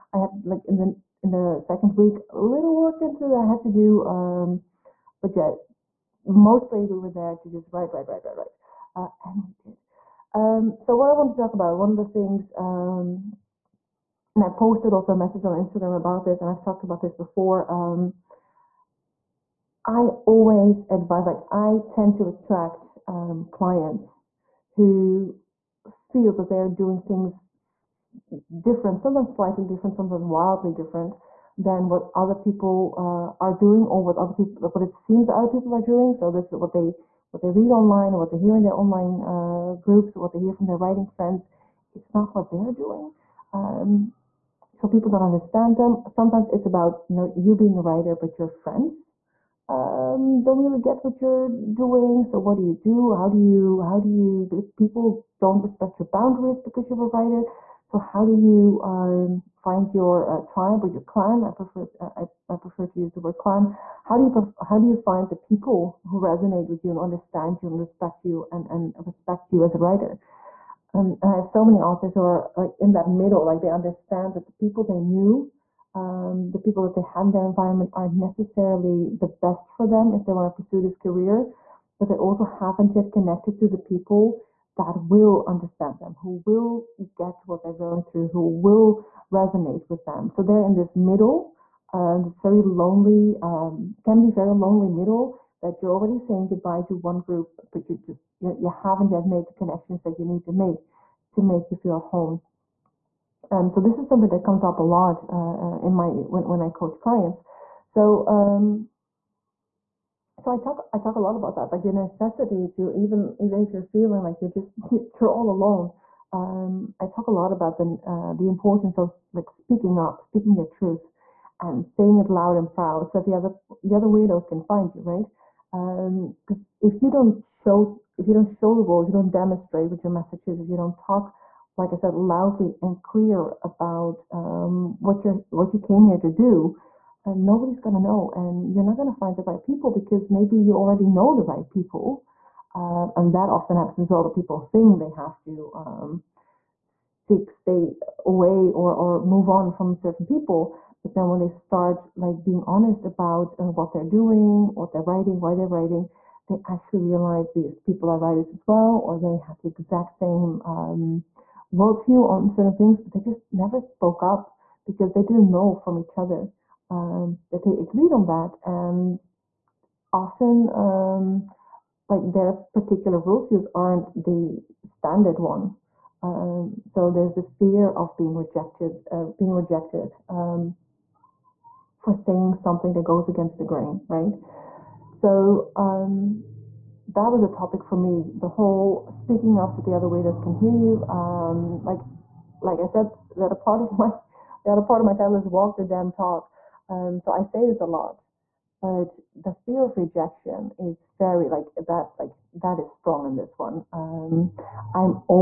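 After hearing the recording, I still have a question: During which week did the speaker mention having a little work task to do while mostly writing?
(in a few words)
second week.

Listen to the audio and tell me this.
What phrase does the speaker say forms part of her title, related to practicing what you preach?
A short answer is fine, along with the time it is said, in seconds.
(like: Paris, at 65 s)
walk the damn talk, at 195 s.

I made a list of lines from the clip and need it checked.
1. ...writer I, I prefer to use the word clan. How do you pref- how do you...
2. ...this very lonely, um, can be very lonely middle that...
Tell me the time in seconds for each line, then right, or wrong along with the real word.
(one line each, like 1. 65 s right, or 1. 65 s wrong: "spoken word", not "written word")
1. 61 s wrong: "prefer", not "writer"
2. 92 s right.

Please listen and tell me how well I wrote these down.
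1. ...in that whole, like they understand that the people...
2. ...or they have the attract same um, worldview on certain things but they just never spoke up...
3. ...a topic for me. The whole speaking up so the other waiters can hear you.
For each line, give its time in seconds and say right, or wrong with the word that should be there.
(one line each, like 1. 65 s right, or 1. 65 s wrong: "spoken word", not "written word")
1. 72 s wrong: "middle", not "whole"
2. 159 s wrong: "exact", not "attract"
3. 187 s right.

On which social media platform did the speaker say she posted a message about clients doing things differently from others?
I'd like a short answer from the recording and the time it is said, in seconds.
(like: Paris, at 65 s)
Instagram, at 15 s.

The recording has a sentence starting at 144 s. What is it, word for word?
That people think they have to.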